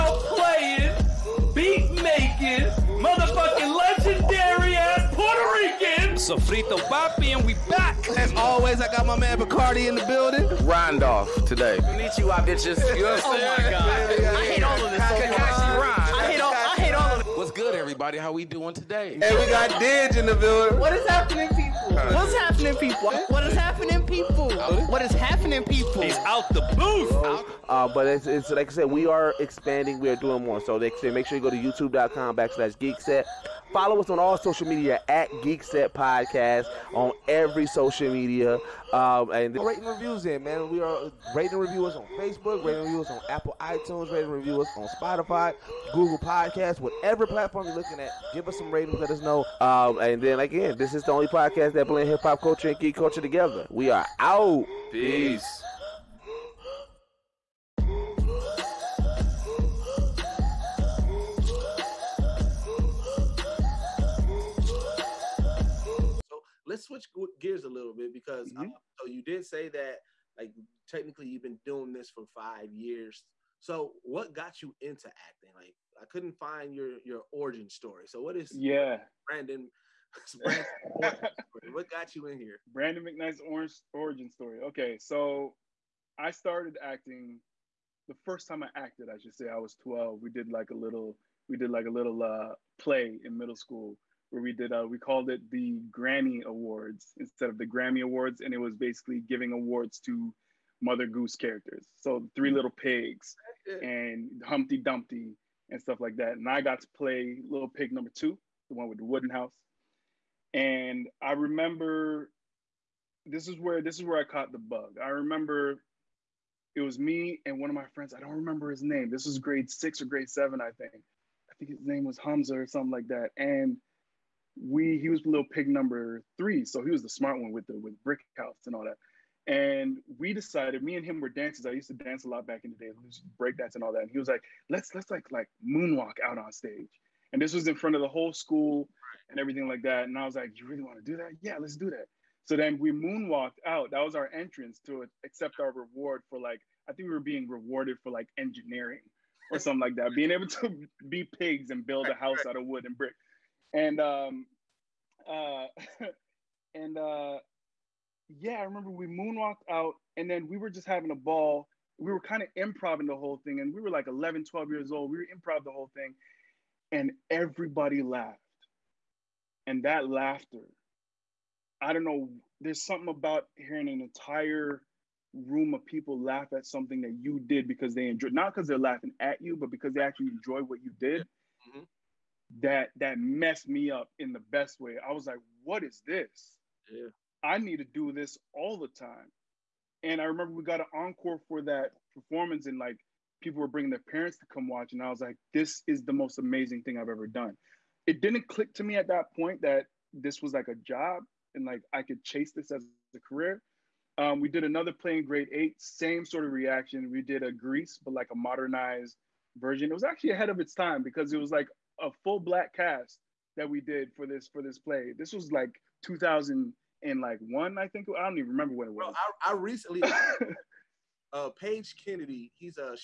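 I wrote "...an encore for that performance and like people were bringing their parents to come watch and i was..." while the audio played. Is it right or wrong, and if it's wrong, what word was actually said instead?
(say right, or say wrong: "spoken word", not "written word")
right.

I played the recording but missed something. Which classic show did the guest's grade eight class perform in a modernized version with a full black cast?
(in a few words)
Grease.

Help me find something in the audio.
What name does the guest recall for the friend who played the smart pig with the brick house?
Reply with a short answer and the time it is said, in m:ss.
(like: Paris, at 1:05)
Hamza, at 2:02.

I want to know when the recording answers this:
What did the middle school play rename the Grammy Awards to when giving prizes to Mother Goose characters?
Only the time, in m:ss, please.
1:35.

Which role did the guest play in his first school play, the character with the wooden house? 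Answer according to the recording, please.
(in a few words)
Little Pig number two.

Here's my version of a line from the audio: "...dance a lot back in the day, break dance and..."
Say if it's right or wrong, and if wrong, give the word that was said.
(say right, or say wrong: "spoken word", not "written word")
right.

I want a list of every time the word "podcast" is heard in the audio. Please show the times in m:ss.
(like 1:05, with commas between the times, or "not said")
0:35, 0:46, 0:51.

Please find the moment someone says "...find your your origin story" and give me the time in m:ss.
1:16.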